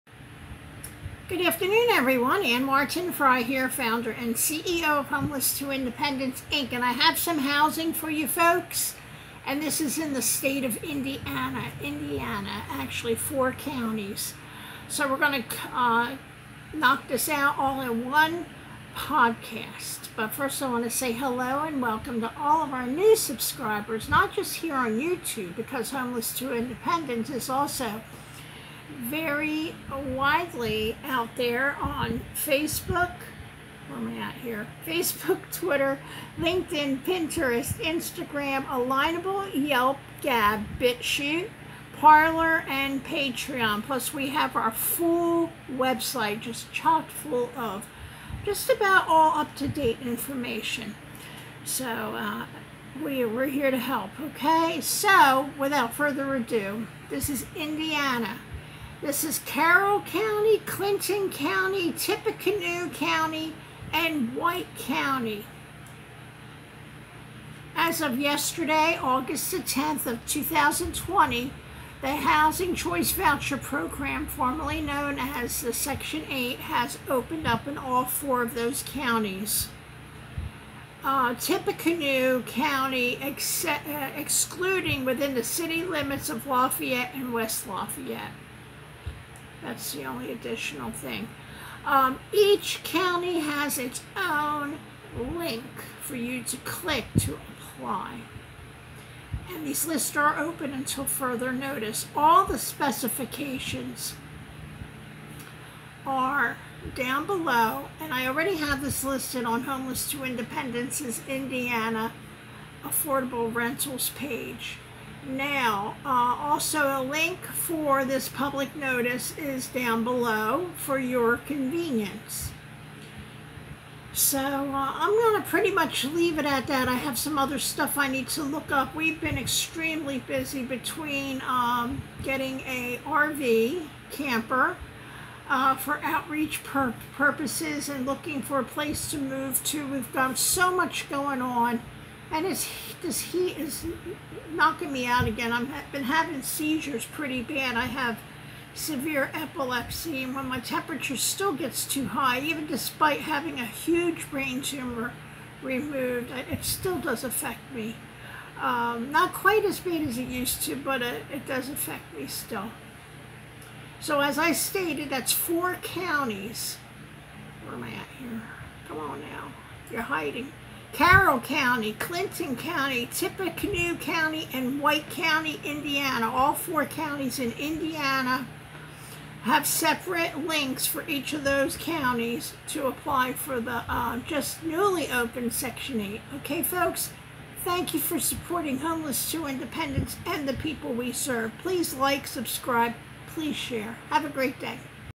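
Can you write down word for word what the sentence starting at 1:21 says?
Uh, Tippecanoe County, ex uh, excluding within the city limits of Lafayette and West Lafayette.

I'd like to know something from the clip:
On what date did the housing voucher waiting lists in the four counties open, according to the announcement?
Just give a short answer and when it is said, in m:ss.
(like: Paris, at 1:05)
August 10, 2020, at 1:09.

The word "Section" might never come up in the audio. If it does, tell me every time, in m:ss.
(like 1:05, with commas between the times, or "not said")
1:15, 3:05.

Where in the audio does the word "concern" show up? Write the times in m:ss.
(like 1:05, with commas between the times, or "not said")
not said.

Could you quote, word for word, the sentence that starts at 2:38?
Um, not quite as bad as it used to, but it, it does affect me still.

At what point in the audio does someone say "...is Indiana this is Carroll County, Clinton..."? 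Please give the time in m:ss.
0:57.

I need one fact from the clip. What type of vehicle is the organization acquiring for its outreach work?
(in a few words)
RV camper.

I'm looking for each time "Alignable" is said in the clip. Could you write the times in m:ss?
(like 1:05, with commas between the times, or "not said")
0:38.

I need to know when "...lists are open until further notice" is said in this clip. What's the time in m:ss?
1:39.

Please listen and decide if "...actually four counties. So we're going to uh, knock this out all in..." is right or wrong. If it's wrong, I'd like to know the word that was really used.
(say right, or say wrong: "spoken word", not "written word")
right.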